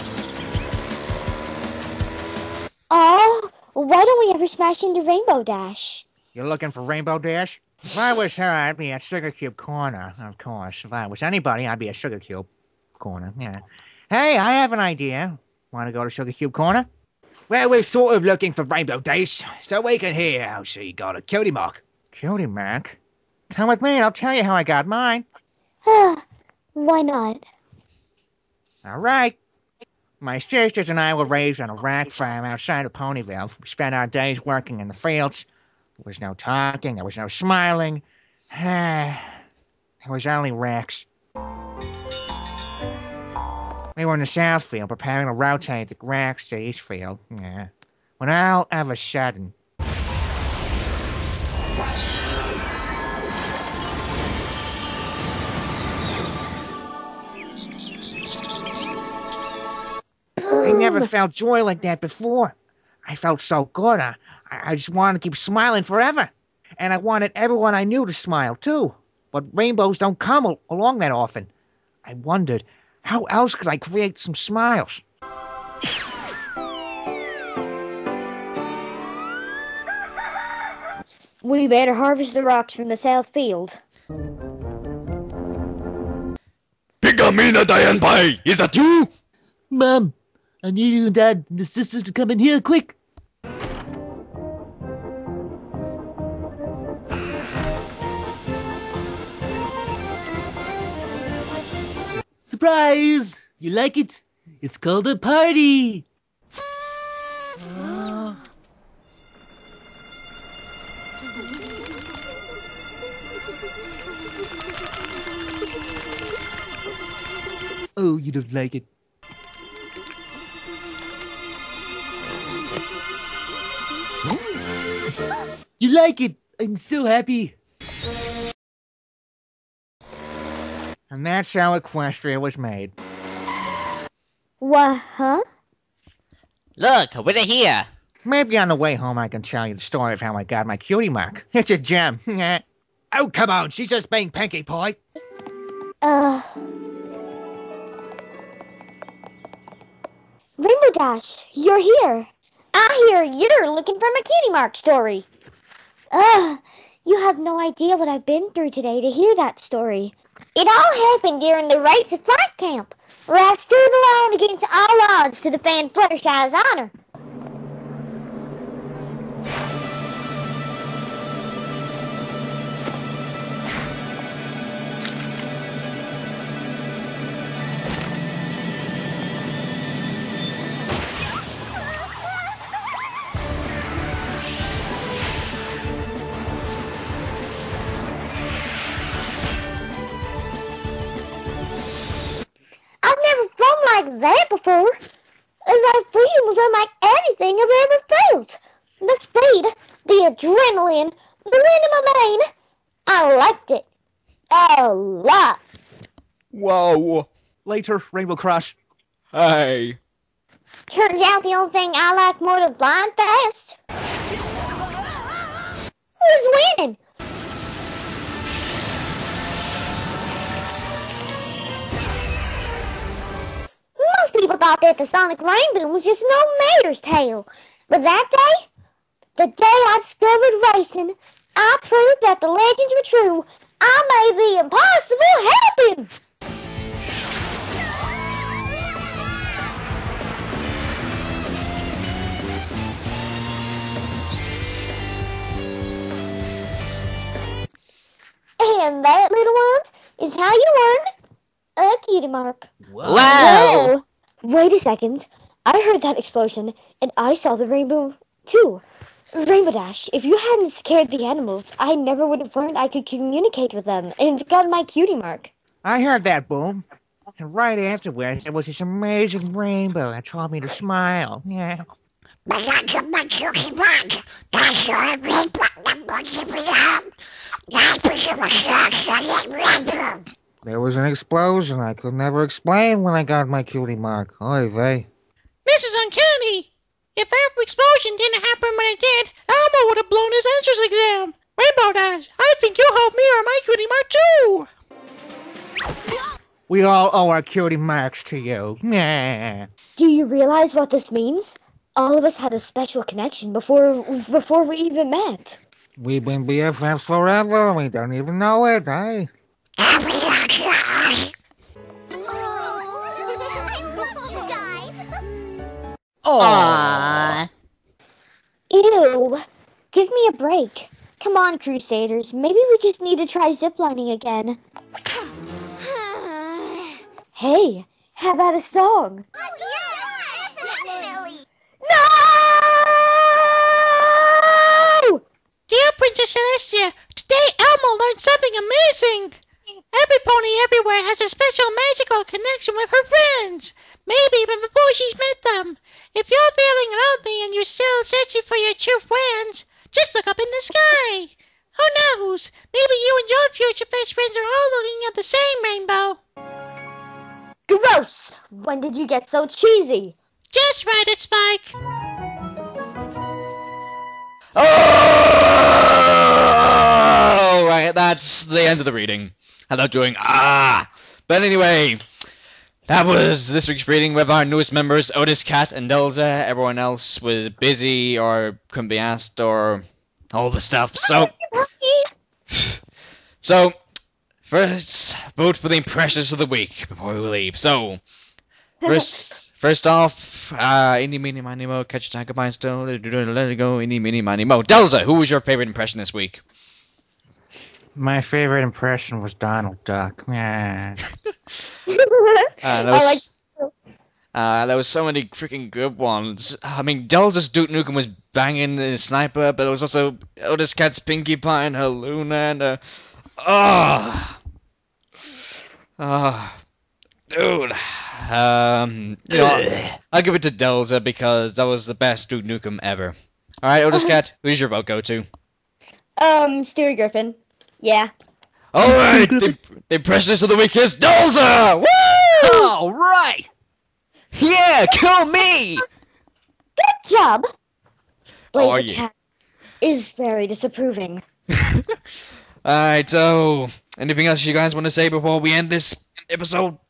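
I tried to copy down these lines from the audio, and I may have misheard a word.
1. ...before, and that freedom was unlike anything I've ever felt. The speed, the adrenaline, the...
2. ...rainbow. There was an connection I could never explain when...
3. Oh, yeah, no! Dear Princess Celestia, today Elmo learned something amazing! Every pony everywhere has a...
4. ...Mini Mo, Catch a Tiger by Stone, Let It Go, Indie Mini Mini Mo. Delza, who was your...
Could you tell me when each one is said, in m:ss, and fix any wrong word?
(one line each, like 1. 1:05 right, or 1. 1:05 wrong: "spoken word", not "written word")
1. 3:14 right
2. 4:39 wrong: "explosion", not "connection"
3. 5:29 right
4. 6:31 right.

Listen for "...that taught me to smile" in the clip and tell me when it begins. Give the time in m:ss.
4:30.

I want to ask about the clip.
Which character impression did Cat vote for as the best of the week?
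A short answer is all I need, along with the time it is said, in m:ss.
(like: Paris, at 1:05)
Stewie Griffin, at 7:06.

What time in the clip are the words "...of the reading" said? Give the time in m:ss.
6:08.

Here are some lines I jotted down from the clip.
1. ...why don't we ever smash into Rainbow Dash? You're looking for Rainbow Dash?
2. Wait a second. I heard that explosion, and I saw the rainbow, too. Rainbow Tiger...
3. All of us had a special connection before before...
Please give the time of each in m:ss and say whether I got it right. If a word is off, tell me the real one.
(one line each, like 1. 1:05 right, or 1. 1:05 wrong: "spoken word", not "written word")
1. 0:03 right
2. 4:14 wrong: "Dash", not "Tiger"
3. 5:01 right.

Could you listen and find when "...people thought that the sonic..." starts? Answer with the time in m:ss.
3:44.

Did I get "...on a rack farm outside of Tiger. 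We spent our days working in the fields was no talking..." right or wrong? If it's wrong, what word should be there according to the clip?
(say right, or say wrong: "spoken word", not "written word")
wrong: "Ponyville", not "Tiger".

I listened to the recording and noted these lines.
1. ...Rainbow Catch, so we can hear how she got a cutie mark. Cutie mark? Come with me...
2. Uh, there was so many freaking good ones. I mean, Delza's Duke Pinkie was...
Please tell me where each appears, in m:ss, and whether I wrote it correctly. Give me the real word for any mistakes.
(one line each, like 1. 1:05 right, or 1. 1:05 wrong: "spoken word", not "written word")
1. 0:18 wrong: "Dash", not "Catch"
2. 6:44 wrong: "Nukem", not "Pinkie".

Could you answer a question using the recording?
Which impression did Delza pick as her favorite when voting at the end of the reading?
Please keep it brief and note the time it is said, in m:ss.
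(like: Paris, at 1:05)
Donald Duck, at 6:39.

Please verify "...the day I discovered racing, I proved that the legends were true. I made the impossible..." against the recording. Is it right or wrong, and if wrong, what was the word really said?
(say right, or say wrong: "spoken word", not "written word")
right.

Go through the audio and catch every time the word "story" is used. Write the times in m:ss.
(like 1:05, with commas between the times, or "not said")
2:19, 2:34, 2:39.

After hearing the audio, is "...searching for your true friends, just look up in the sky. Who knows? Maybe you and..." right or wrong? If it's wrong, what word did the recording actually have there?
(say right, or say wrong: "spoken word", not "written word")
right.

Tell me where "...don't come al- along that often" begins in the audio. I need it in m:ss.
1:09.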